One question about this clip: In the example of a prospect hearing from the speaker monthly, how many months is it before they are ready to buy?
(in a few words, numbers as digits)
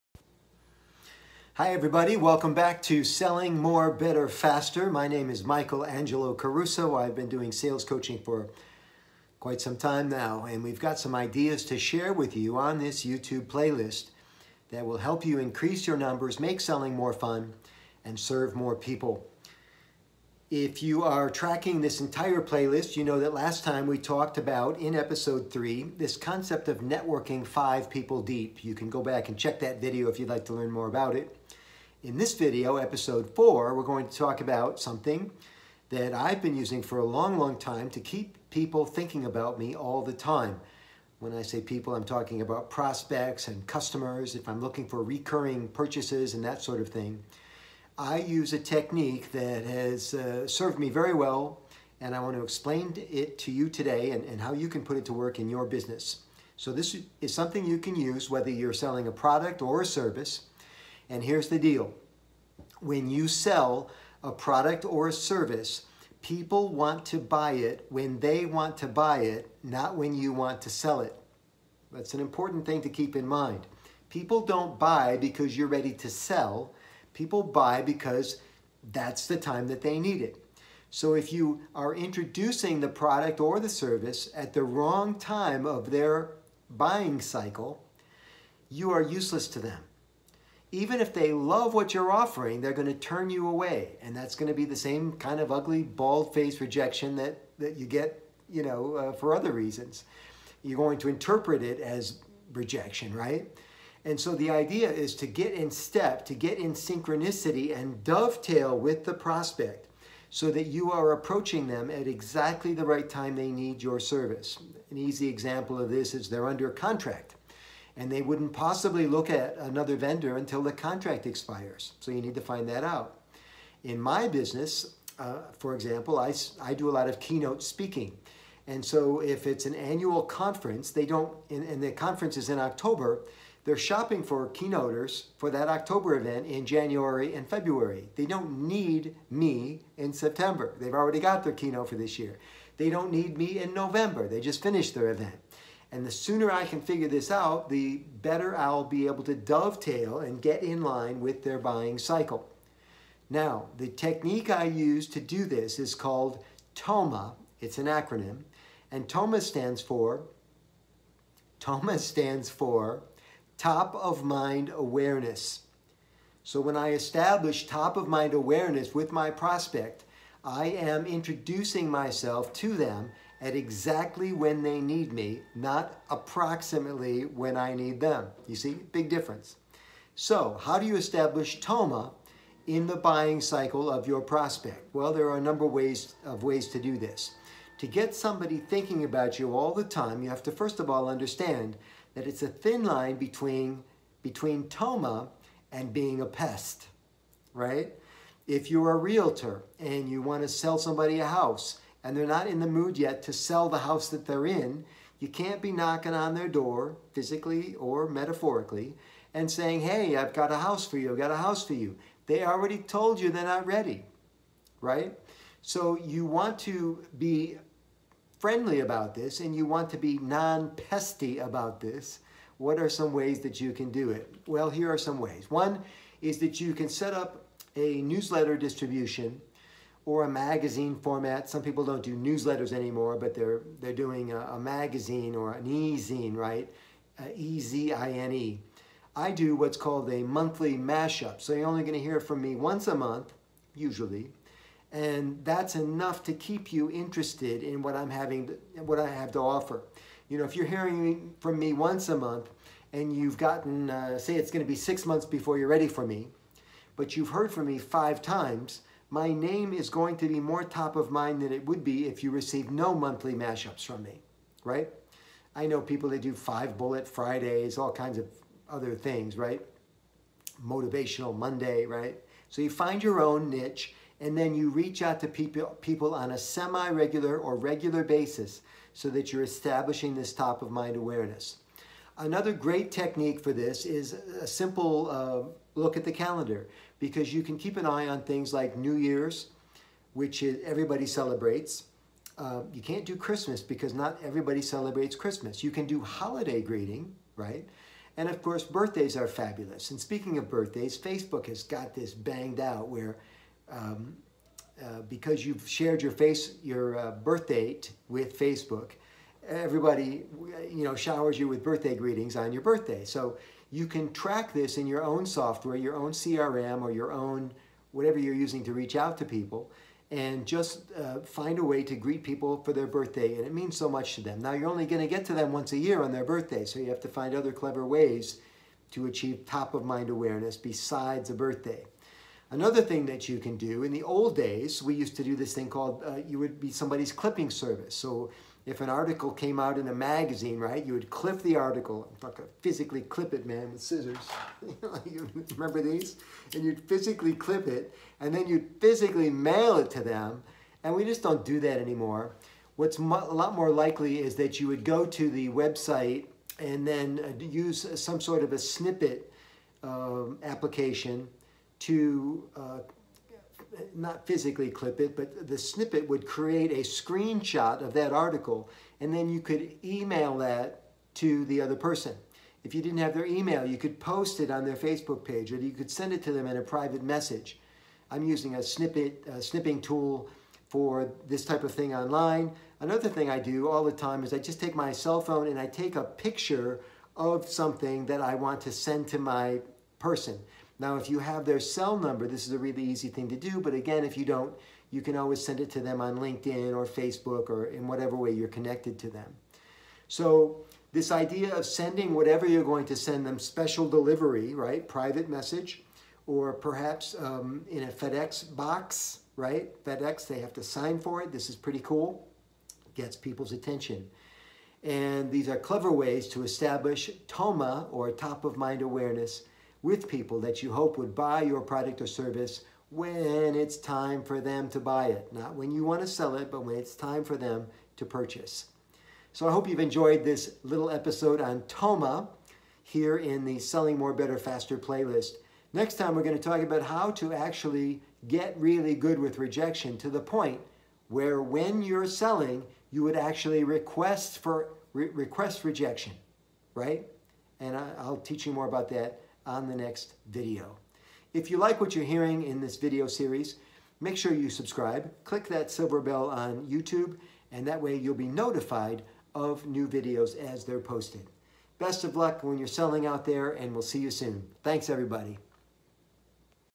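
6.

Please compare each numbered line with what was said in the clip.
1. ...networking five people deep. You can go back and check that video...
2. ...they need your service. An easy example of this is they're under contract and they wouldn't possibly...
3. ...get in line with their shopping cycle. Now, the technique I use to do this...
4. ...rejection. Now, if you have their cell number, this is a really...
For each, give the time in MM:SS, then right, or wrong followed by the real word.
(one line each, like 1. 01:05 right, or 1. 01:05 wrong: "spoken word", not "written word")
1. 00:26 right
2. 01:53 right
3. 02:30 wrong: "buying", not "shopping"
4. 06:29 wrong: "person", not "rejection".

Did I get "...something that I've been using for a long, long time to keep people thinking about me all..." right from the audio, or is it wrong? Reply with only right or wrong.
right.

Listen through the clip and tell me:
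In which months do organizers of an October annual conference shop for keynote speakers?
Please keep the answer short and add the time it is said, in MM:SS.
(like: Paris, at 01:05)
January and February, at 02:16.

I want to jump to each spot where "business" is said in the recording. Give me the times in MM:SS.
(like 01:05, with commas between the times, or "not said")
00:55, 02:04.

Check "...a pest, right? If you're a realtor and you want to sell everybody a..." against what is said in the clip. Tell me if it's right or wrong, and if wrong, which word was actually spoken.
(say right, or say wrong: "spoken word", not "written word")
wrong: "somebody", not "everybody".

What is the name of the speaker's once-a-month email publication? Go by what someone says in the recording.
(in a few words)
Monthly mashup.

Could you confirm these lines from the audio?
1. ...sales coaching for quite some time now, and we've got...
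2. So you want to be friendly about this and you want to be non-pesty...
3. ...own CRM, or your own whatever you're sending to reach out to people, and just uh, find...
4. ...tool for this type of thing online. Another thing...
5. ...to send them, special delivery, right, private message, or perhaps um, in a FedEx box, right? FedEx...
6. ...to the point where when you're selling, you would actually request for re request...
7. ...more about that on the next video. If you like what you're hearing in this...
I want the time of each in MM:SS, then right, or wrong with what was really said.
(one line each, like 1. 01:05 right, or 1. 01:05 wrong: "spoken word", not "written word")
1. 00:07 right
2. 03:35 right
3. 05:15 wrong: "using", not "sending"
4. 06:19 right
5. 06:42 right
6. 07:19 right
7. 07:28 right.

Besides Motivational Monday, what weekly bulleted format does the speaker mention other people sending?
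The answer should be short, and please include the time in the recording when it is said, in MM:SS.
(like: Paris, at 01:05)
Five bullet Fridays, at 04:26.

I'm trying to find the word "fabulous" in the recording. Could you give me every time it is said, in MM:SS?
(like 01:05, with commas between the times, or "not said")
04:59.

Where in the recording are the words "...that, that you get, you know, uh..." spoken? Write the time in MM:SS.
01:37.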